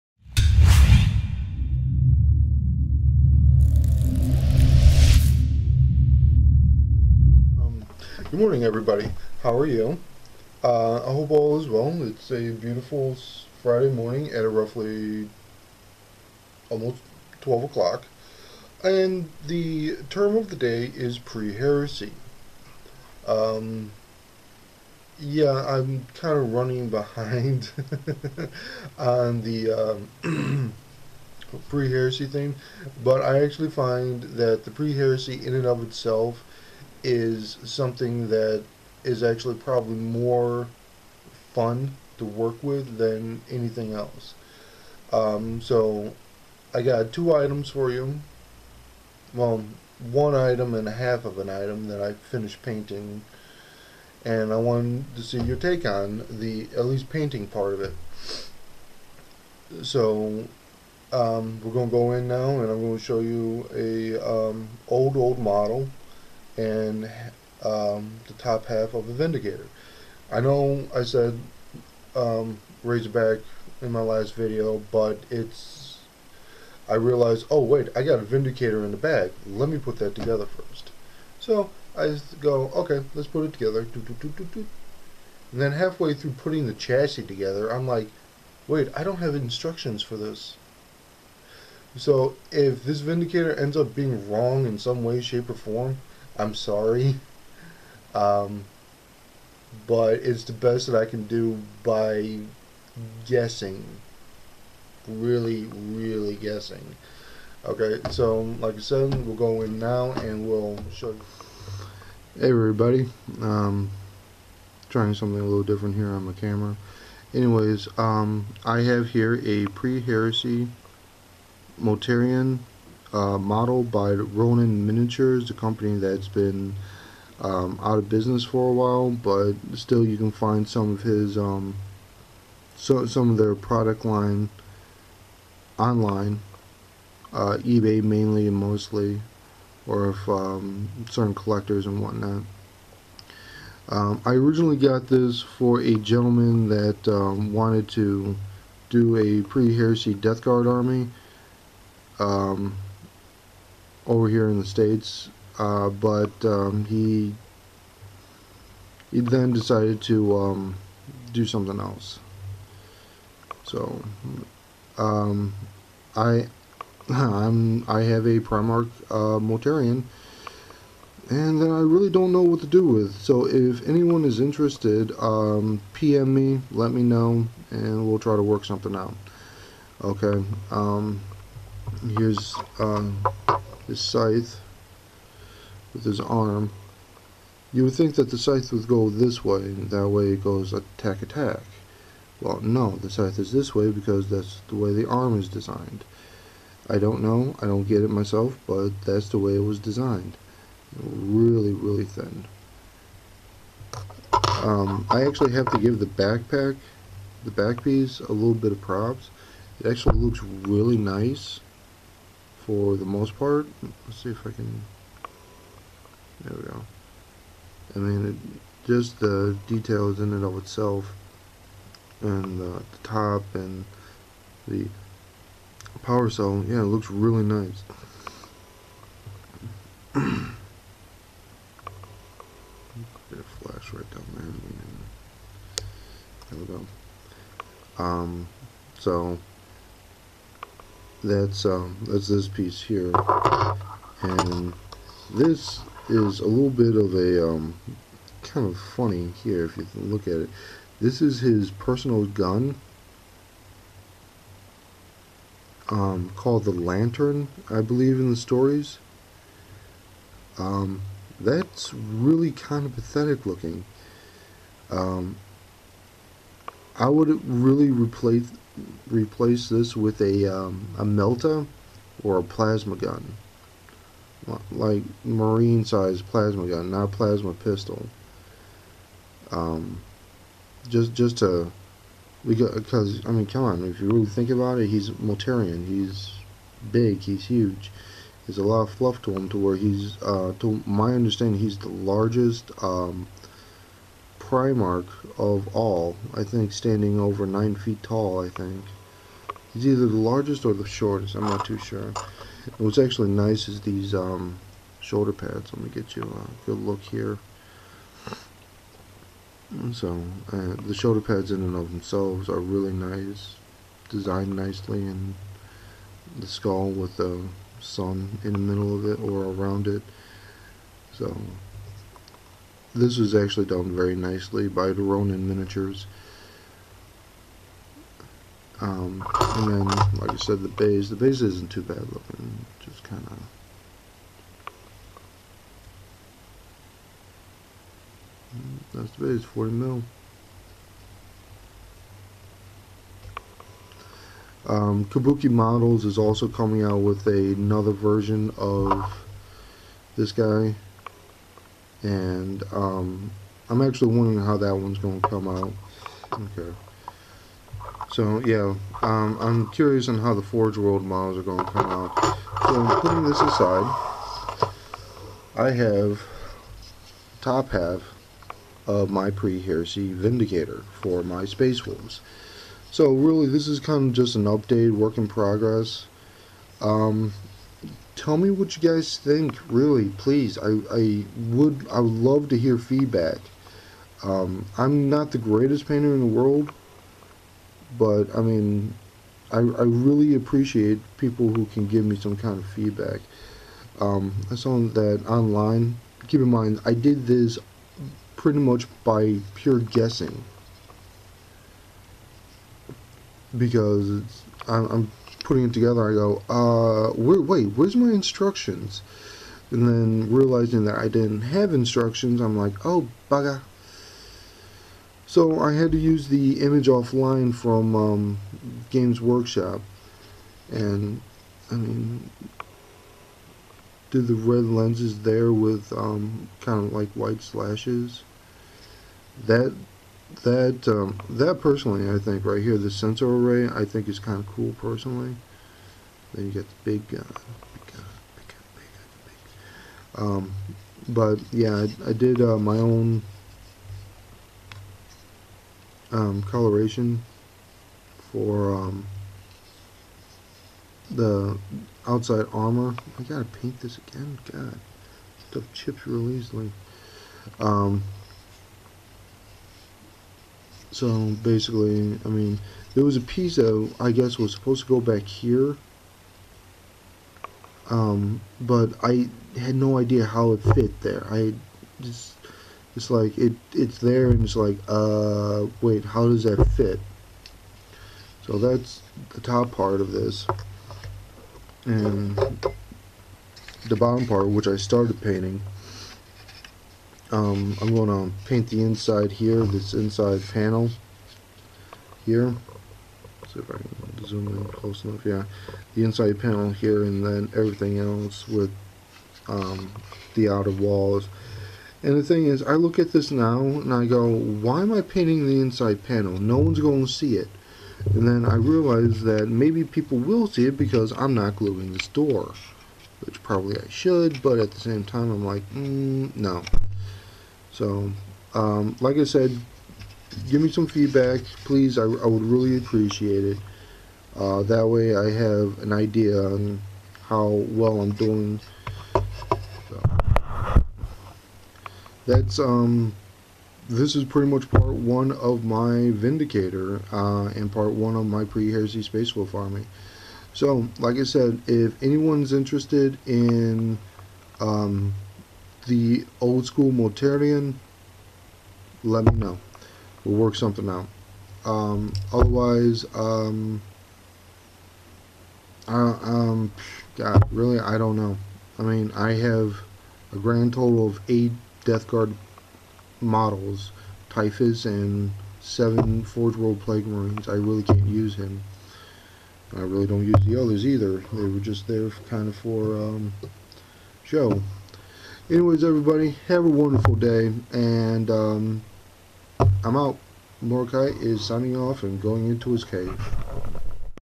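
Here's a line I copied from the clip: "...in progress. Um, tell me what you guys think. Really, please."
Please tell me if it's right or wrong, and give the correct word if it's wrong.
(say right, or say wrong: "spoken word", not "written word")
right.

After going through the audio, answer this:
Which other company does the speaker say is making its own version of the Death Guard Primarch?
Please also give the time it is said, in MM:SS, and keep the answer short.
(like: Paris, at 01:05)
Kabuki Models, at 05:45.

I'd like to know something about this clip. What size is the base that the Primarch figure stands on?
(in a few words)
40 mil.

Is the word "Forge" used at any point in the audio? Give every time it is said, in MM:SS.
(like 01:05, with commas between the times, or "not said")
06:00, 09:26.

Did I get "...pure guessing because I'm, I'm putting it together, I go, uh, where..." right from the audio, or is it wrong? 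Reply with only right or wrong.
right.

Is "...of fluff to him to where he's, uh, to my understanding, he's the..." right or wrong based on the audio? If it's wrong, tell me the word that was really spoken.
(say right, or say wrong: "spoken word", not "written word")
right.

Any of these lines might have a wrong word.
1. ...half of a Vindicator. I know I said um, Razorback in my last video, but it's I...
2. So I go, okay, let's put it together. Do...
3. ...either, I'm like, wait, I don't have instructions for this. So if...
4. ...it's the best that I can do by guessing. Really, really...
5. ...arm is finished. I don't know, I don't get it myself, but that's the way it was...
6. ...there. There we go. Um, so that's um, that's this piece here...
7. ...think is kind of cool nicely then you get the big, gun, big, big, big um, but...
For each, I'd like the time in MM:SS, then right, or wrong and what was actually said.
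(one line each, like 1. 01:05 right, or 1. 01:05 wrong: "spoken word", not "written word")
1. 01:08 right
2. 01:21 right
3. 01:27 wrong: "together", not "either"
4. 01:40 right
5. 03:15 wrong: "designed", not "finished"
6. 03:55 right
7. 07:13 wrong: "personally", not "nicely".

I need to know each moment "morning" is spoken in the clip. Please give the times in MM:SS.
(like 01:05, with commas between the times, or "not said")
00:08, 00:13.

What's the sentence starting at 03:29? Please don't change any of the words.
It actually looks really nice for the most part.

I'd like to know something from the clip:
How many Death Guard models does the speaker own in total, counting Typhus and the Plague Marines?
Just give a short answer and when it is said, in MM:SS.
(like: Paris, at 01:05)
8, at 09:21.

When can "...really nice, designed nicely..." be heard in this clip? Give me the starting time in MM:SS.
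05:12.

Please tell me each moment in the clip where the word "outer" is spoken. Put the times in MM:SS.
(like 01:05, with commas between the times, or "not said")
08:20.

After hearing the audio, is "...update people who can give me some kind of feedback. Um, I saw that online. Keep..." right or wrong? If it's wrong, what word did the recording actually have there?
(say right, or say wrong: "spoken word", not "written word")
wrong: "appreciate", not "update".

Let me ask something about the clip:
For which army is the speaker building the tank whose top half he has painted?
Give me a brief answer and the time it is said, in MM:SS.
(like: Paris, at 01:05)
Space Wolves, at 06:11.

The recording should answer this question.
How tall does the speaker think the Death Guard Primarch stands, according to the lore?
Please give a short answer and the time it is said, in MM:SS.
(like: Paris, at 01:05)
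over 9 feet, at 04:57.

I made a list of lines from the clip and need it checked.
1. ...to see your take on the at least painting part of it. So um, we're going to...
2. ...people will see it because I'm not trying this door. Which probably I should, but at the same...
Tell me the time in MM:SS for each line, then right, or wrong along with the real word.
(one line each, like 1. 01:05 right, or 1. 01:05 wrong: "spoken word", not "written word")
1. 00:55 right
2. 08:29 wrong: "gluing", not "trying".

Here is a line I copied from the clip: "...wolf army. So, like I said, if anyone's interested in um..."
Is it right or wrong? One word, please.
right.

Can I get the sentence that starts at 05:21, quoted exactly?
So, this is actually done very nicely by the Ronin Miniatures.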